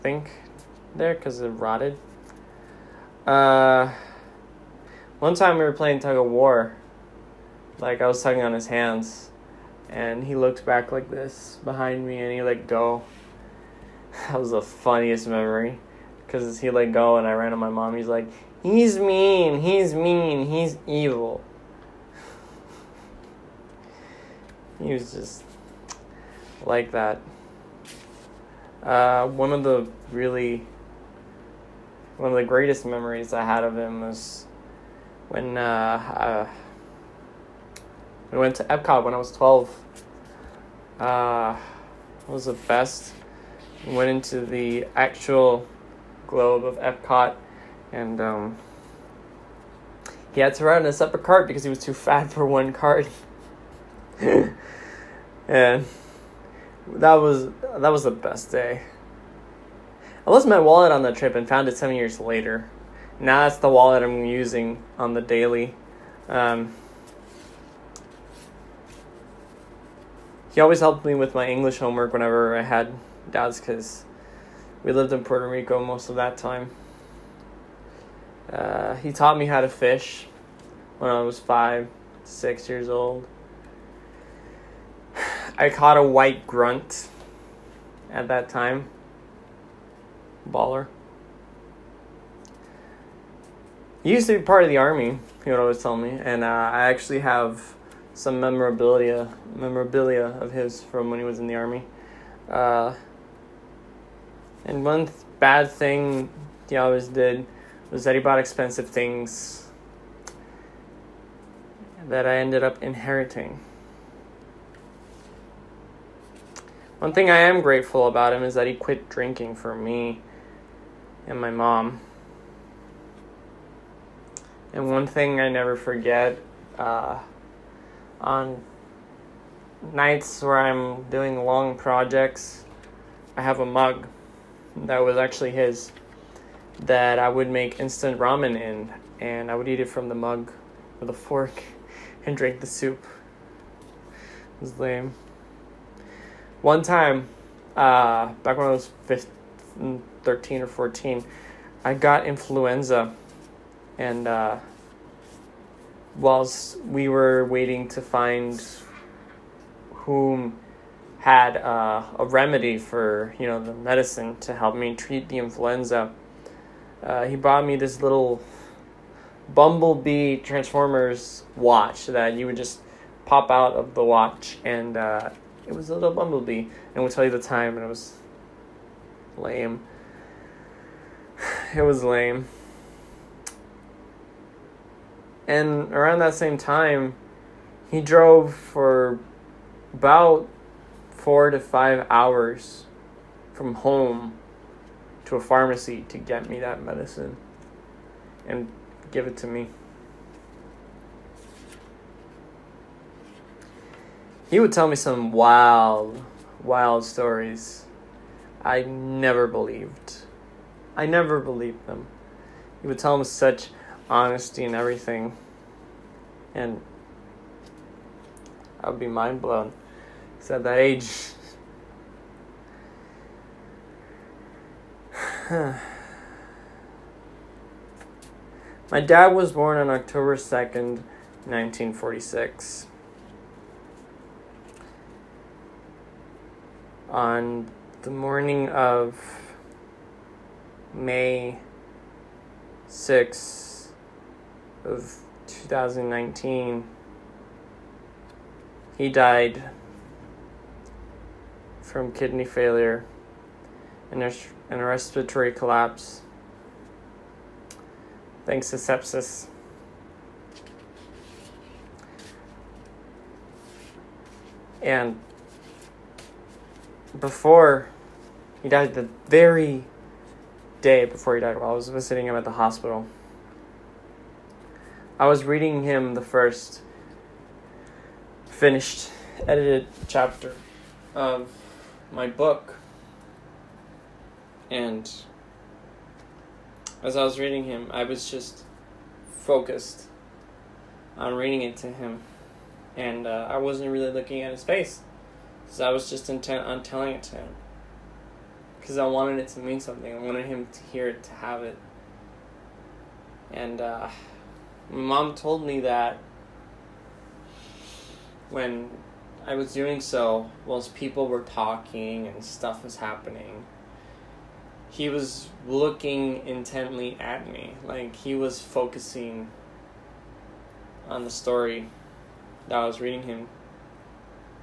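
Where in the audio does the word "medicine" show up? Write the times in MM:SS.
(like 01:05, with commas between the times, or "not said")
02:43, 03:16.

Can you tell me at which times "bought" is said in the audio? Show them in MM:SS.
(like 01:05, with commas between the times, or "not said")
01:48, 02:47.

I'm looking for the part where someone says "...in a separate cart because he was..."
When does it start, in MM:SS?
00:50.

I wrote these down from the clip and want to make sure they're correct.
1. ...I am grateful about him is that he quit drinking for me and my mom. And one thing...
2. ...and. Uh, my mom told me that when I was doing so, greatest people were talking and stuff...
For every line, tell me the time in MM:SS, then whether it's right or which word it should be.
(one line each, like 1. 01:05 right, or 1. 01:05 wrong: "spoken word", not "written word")
1. 01:57 right
2. 05:03 wrong: "whilst", not "greatest".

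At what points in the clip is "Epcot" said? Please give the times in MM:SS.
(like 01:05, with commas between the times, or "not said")
00:38, 00:46.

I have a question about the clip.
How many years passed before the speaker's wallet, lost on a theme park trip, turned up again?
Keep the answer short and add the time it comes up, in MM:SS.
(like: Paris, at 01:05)
7, at 01:01.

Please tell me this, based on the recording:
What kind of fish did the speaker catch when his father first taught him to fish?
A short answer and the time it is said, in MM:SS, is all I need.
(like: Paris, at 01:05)
White grunt, at 01:26.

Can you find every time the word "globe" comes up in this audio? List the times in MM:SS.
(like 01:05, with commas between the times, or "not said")
00:46.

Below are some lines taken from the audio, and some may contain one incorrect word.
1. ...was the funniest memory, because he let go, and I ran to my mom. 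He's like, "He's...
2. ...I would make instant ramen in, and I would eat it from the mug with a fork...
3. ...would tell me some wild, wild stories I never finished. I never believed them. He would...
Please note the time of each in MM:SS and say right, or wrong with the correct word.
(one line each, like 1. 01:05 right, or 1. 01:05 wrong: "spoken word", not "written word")
1. 00:14 right
2. 02:17 right
3. 03:24 wrong: "believed", not "finished".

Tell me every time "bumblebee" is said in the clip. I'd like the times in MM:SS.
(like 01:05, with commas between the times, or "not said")
02:49, 02:56.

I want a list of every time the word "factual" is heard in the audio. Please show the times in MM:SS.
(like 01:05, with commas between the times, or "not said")
not said.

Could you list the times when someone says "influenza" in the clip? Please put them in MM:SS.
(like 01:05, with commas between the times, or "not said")
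02:32, 02:45.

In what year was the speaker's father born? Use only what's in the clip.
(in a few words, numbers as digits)
1946.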